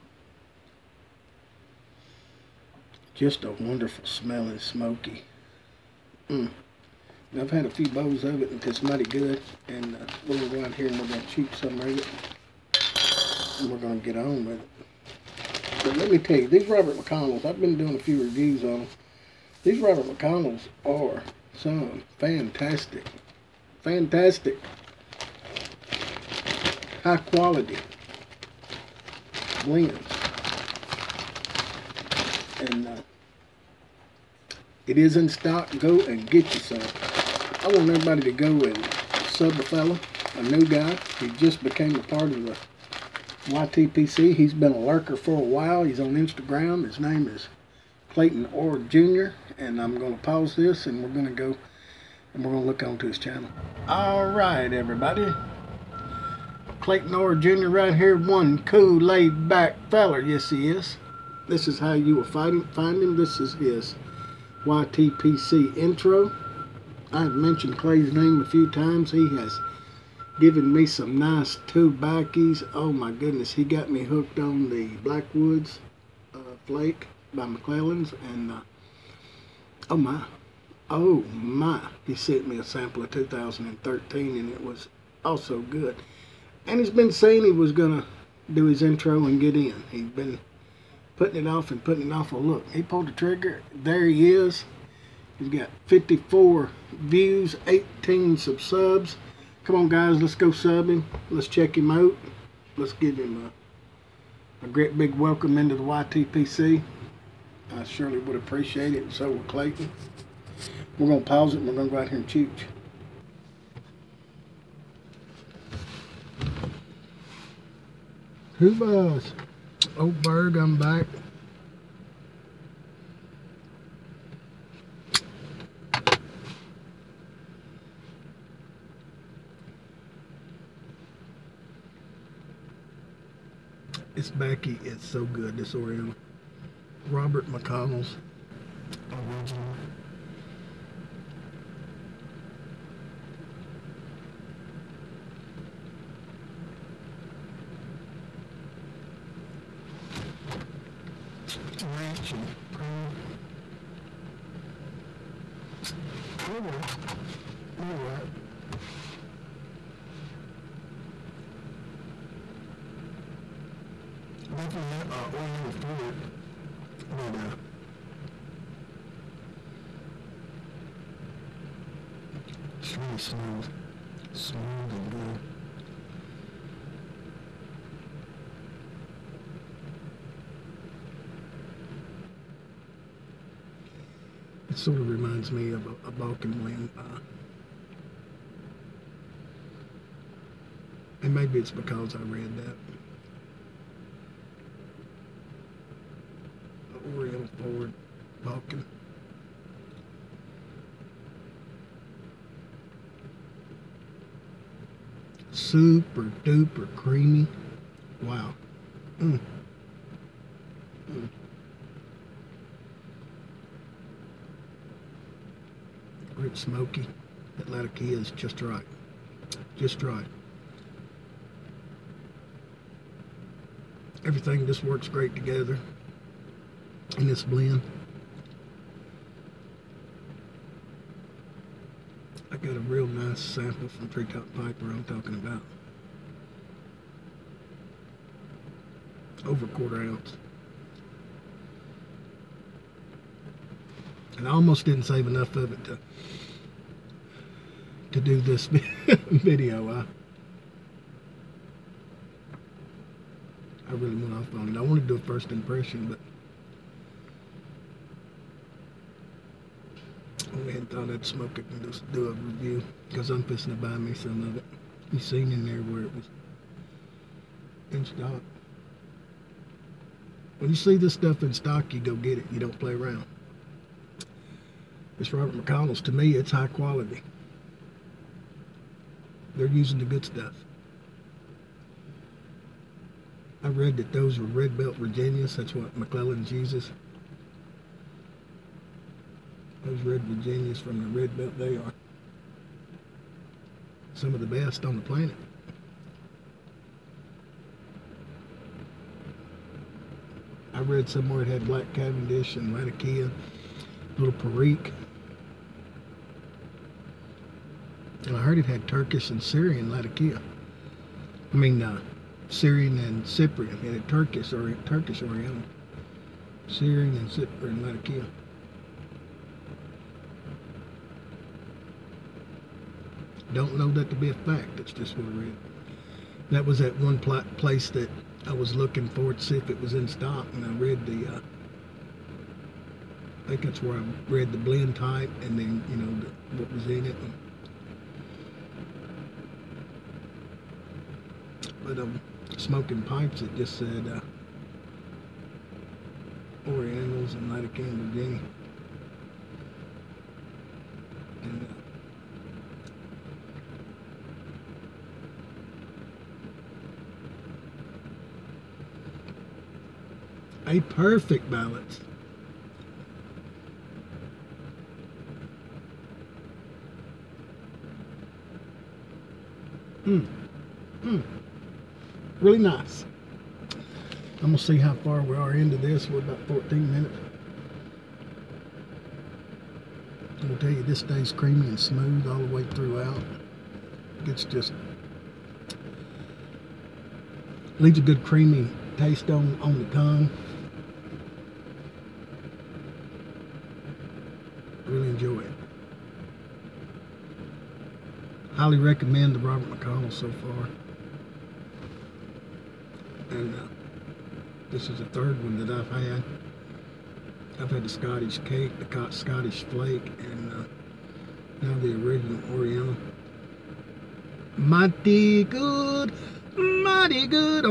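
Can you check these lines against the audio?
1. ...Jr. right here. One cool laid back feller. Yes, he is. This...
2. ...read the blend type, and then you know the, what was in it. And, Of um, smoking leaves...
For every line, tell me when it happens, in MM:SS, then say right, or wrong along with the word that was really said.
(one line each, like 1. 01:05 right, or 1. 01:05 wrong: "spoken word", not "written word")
1. 00:57 right
2. 05:34 wrong: "pipes", not "leaves".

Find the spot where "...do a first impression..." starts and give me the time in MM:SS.
04:15.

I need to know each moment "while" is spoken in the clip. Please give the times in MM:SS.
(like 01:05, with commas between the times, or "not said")
00:45.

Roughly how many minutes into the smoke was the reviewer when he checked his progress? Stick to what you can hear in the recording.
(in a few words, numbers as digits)
14.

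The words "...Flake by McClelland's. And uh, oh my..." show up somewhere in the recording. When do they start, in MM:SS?
01:16.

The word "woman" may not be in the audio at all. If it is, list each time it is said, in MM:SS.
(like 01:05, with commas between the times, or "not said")
not said.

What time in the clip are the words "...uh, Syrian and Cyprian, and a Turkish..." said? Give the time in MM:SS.
05:11.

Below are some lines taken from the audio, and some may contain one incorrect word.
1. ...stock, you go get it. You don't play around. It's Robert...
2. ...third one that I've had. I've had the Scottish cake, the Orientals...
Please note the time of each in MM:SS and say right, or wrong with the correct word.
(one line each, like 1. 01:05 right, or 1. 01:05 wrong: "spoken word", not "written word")
1. 04:31 right
2. 06:45 wrong: "Scottish", not "Orientals".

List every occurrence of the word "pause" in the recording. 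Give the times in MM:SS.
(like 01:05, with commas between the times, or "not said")
00:50, 01:51.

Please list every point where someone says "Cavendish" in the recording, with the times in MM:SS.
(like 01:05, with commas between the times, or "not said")
05:01.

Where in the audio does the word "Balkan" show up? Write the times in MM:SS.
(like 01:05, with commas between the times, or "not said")
03:06, 03:18.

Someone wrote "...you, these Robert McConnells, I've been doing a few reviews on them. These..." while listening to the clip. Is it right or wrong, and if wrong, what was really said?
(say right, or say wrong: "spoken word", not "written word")
right.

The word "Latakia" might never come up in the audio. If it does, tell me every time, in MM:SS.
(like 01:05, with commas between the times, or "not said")
05:02, 05:09, 05:17, 05:47.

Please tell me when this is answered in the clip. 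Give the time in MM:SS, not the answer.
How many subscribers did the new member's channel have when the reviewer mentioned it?
01:37.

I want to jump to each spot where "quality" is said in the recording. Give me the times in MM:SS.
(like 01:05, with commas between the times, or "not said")
00:27, 04:36.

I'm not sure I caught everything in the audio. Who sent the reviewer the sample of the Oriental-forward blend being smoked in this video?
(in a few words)
Treetop Piper.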